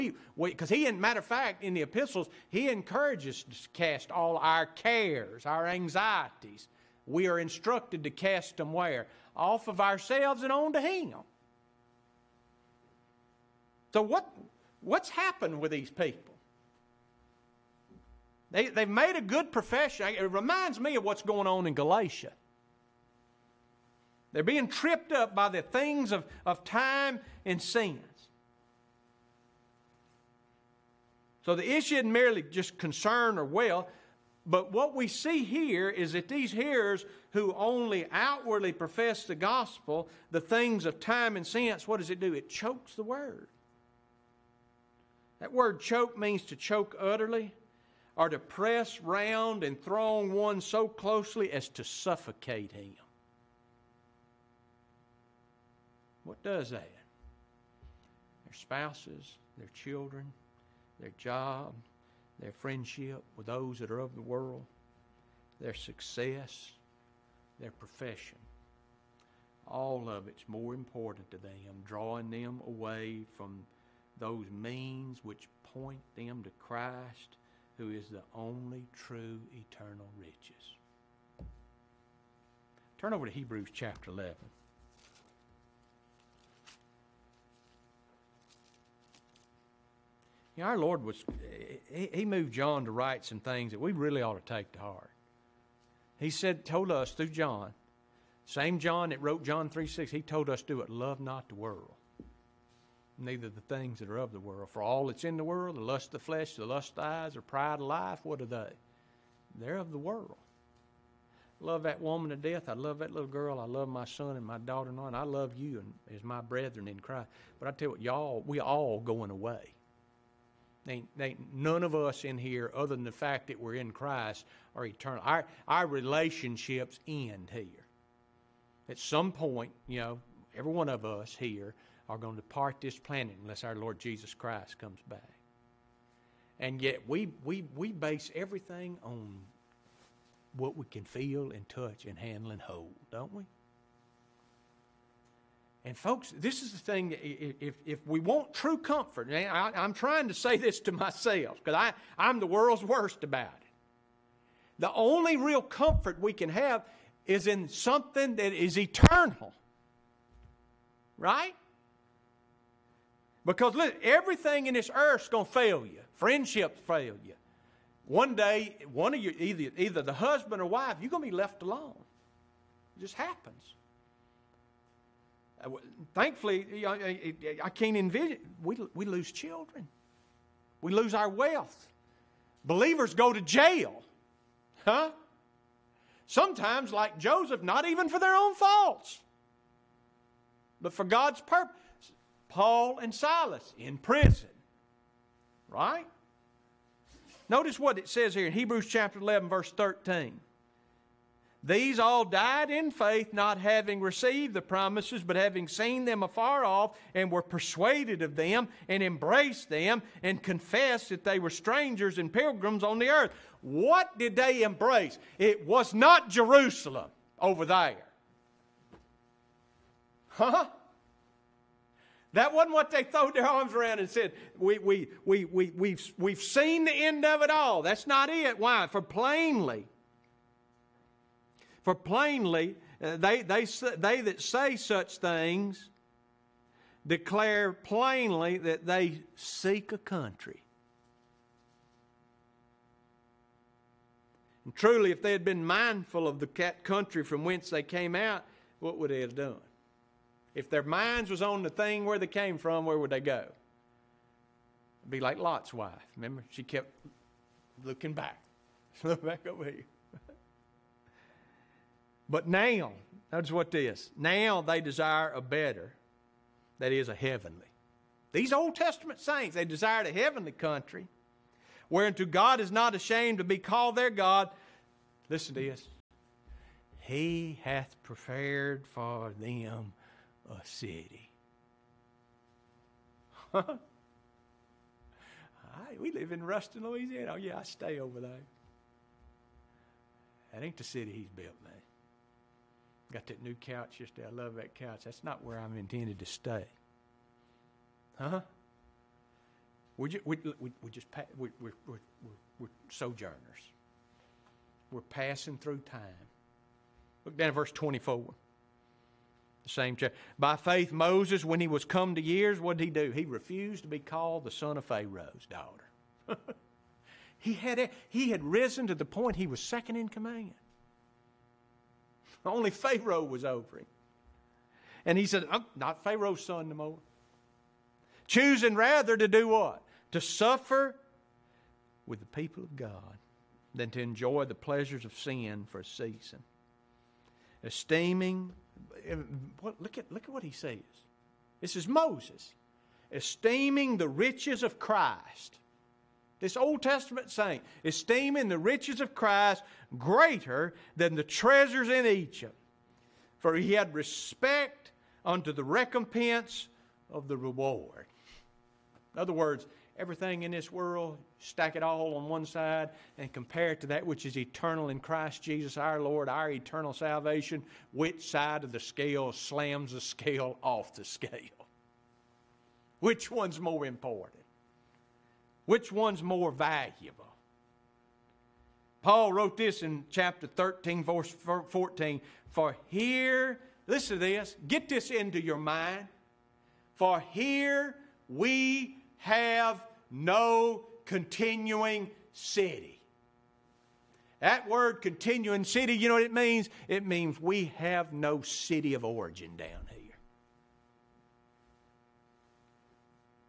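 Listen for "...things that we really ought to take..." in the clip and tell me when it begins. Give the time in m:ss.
1:33.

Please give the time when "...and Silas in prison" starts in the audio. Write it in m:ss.
3:12.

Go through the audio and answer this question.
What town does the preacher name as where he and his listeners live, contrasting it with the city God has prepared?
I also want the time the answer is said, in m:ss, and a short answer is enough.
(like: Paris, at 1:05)
Ruston, Louisiana, at 4:46.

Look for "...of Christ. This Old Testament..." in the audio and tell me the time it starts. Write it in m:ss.
5:44.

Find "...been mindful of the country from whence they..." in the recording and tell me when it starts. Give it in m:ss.
4:05.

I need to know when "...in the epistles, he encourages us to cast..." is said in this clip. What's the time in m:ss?
0:01.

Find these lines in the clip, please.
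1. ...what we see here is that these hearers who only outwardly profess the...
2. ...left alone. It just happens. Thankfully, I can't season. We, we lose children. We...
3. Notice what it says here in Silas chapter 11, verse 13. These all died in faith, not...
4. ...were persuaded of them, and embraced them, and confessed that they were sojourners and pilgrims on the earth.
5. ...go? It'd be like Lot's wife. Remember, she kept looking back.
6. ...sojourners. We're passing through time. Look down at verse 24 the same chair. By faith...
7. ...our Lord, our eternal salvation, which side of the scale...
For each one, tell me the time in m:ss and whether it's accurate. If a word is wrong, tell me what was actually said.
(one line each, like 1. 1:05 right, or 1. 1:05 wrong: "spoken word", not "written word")
1. 0:34 right
2. 2:51 wrong: "envision", not "season"
3. 3:17 wrong: "Hebrews", not "Silas"
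4. 3:27 wrong: "strangers", not "sojourners"
5. 4:13 right
6. 5:02 right
7. 6:05 right.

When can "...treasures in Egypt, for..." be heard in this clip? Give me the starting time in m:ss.
5:51.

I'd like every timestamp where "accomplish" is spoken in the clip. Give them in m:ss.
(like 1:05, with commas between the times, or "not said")
not said.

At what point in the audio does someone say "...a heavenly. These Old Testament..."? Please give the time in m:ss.
4:27.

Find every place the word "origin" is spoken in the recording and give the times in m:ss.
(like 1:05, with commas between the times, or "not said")
6:39.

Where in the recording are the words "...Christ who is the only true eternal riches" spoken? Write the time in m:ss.
1:16.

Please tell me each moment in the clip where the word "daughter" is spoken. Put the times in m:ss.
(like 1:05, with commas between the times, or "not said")
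1:54, 5:15.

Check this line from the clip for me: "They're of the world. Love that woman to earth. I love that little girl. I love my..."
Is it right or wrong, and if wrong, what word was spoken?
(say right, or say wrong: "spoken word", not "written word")
wrong: "death", not "earth".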